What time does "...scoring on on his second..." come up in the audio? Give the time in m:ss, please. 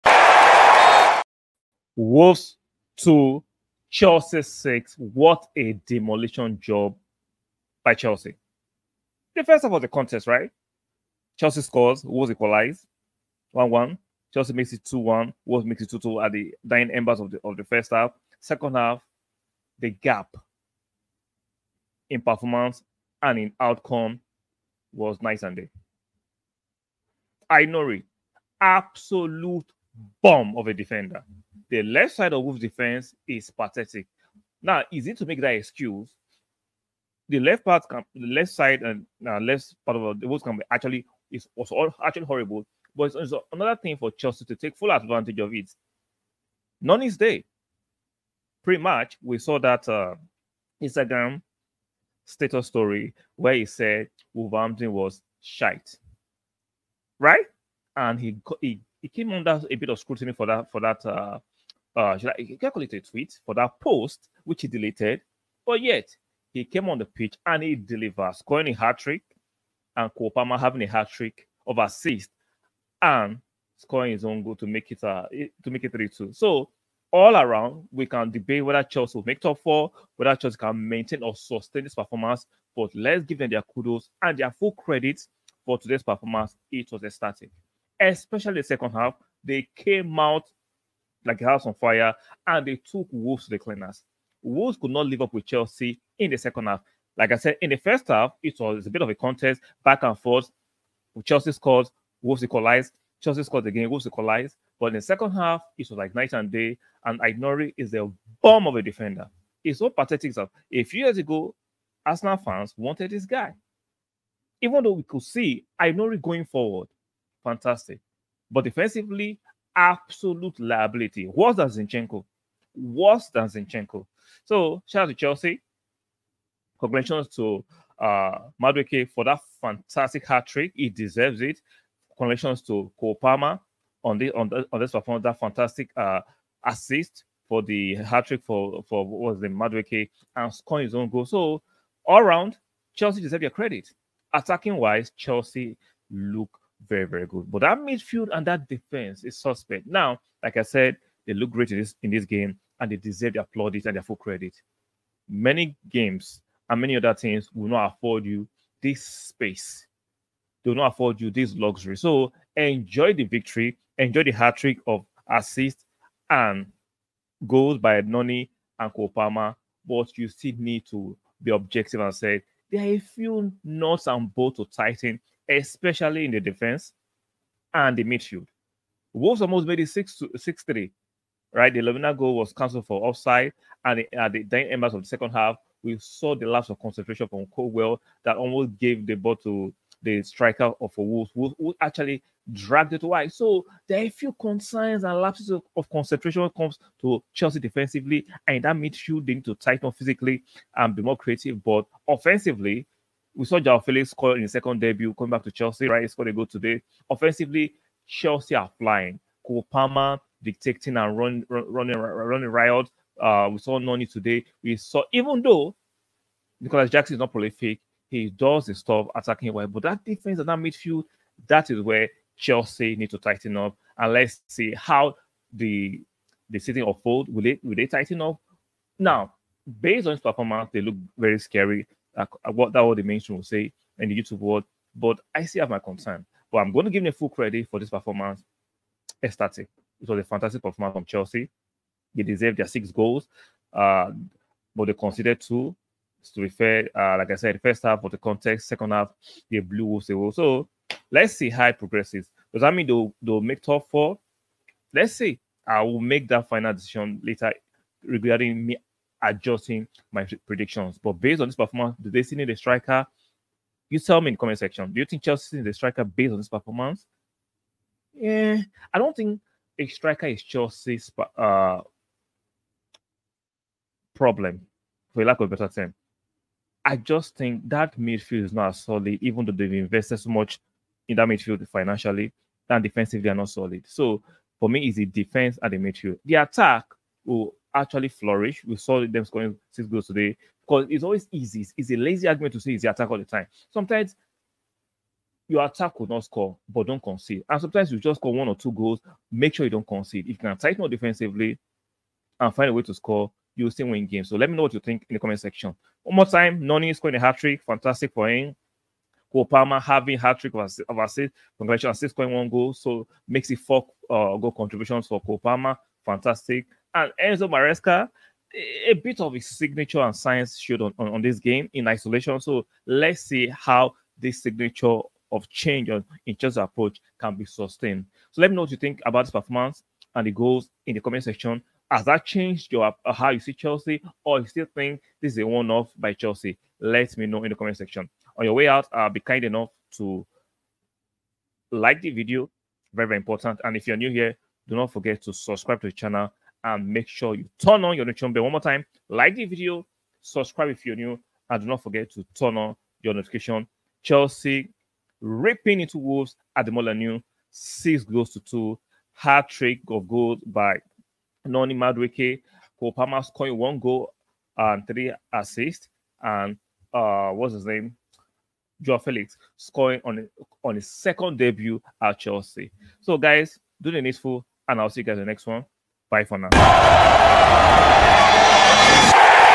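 6:09.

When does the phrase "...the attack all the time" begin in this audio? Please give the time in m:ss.
4:52.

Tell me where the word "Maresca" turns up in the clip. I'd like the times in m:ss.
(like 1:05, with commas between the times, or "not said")
5:17.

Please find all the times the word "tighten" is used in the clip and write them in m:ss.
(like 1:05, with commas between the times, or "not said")
2:54, 3:19, 3:43, 3:47, 5:00.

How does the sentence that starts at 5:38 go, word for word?
On your way out, uh, be kind enough to like the video, very very important.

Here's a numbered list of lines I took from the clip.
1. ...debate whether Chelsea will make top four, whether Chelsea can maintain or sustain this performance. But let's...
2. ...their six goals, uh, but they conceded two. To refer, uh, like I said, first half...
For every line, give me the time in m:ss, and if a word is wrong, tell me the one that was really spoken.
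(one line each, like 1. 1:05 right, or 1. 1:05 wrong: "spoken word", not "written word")
1. 1:18 right
2. 4:02 right.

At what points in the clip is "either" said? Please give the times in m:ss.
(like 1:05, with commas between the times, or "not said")
not said.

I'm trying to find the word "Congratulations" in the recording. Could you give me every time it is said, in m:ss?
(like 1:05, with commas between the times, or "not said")
2:06, 2:12, 5:11.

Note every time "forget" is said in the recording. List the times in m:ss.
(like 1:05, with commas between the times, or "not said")
5:44, 5:51.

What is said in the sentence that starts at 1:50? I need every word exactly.
A few years ago, Arsenal fans wanted this guy.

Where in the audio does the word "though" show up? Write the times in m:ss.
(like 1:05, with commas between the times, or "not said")
1:54, 3:35, 4:39.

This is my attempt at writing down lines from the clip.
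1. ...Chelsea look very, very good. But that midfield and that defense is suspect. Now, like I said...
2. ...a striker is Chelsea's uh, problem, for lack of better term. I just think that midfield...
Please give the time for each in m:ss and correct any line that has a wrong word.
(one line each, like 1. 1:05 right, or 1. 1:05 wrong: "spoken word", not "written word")
1. 2:25 right
2. 4:29 right.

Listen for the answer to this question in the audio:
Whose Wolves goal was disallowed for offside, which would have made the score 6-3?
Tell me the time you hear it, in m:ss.
3:01.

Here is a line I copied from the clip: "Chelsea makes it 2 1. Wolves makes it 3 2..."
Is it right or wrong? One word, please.
wrong.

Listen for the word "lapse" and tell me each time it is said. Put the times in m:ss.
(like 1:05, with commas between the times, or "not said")
3:06, 3:15.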